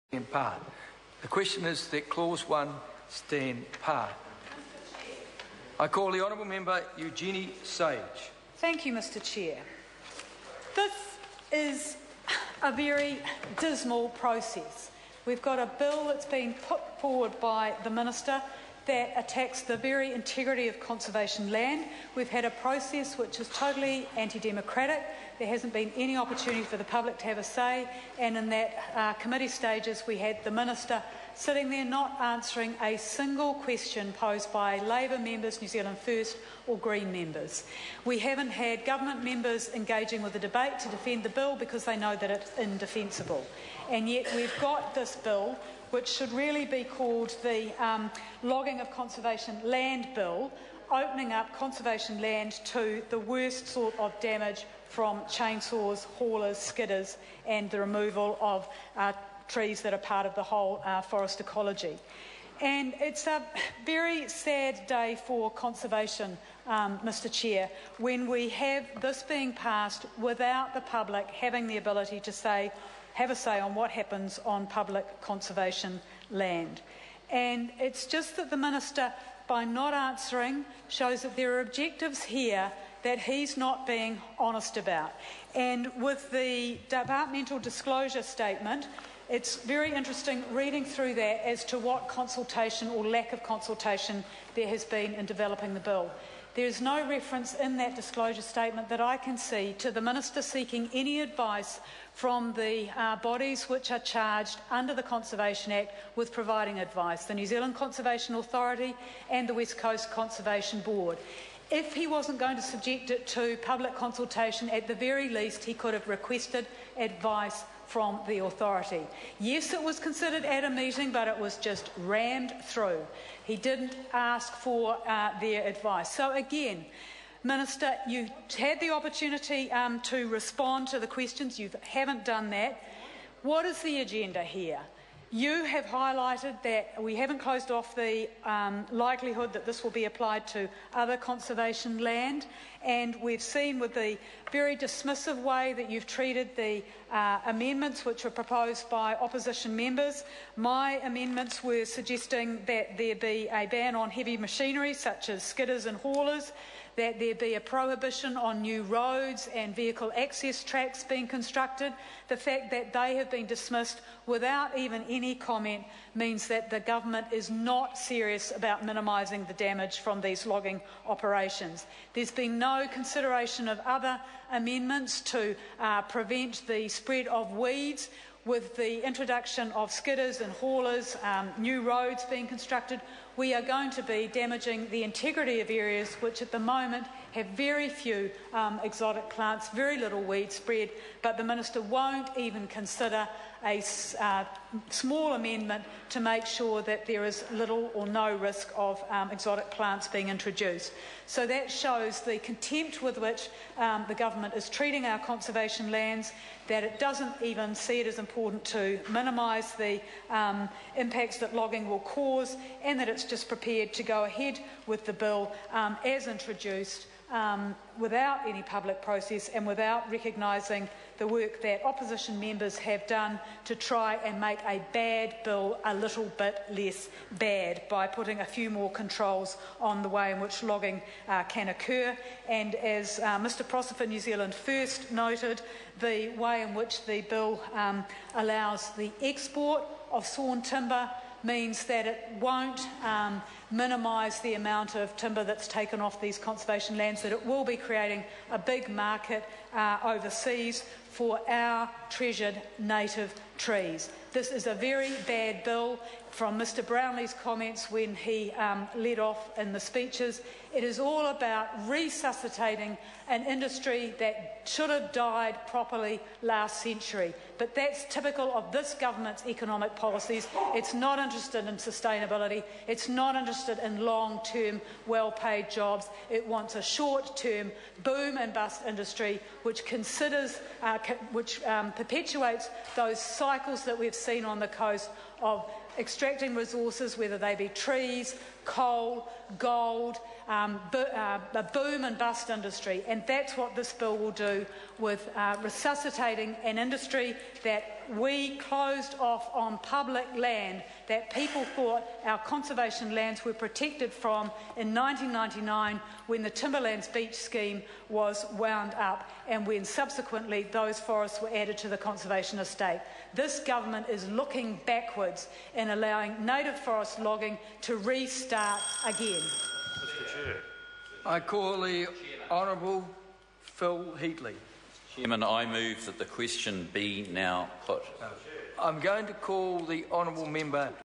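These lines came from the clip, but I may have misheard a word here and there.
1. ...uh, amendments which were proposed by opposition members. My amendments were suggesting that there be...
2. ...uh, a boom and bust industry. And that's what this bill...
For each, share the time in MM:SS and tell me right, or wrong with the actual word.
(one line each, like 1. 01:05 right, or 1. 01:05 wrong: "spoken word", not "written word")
1. 02:27 right
2. 04:51 right.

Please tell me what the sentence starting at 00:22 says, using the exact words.
We've had a process which is totally anti democratic.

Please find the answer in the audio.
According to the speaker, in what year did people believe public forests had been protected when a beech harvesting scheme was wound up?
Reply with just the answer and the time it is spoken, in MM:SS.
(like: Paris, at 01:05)
1999, at 05:04.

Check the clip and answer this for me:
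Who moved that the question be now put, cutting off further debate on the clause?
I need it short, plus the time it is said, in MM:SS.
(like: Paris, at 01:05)
Phil Heatley, at 05:23.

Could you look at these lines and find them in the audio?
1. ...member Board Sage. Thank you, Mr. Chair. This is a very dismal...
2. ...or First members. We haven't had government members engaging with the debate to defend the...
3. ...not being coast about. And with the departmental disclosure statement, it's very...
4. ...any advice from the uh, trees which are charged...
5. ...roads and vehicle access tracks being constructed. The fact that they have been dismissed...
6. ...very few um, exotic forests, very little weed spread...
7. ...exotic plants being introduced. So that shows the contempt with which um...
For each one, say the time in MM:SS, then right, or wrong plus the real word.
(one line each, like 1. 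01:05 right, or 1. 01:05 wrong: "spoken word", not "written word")
1. 00:06 wrong: "Eugenie", not "Board"
2. 00:36 wrong: "Green", not "First"
3. 01:23 wrong: "honest", not "coast"
4. 01:40 wrong: "bodies", not "trees"
5. 02:38 right
6. 03:07 wrong: "plants", not "forests"
7. 03:19 right.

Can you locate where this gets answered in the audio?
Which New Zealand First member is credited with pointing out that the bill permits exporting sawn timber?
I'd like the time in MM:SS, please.
03:53.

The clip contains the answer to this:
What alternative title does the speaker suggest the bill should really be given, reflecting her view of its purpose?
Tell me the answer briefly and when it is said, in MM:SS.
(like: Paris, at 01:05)
Logging of Conservation Land Bill, at 00:48.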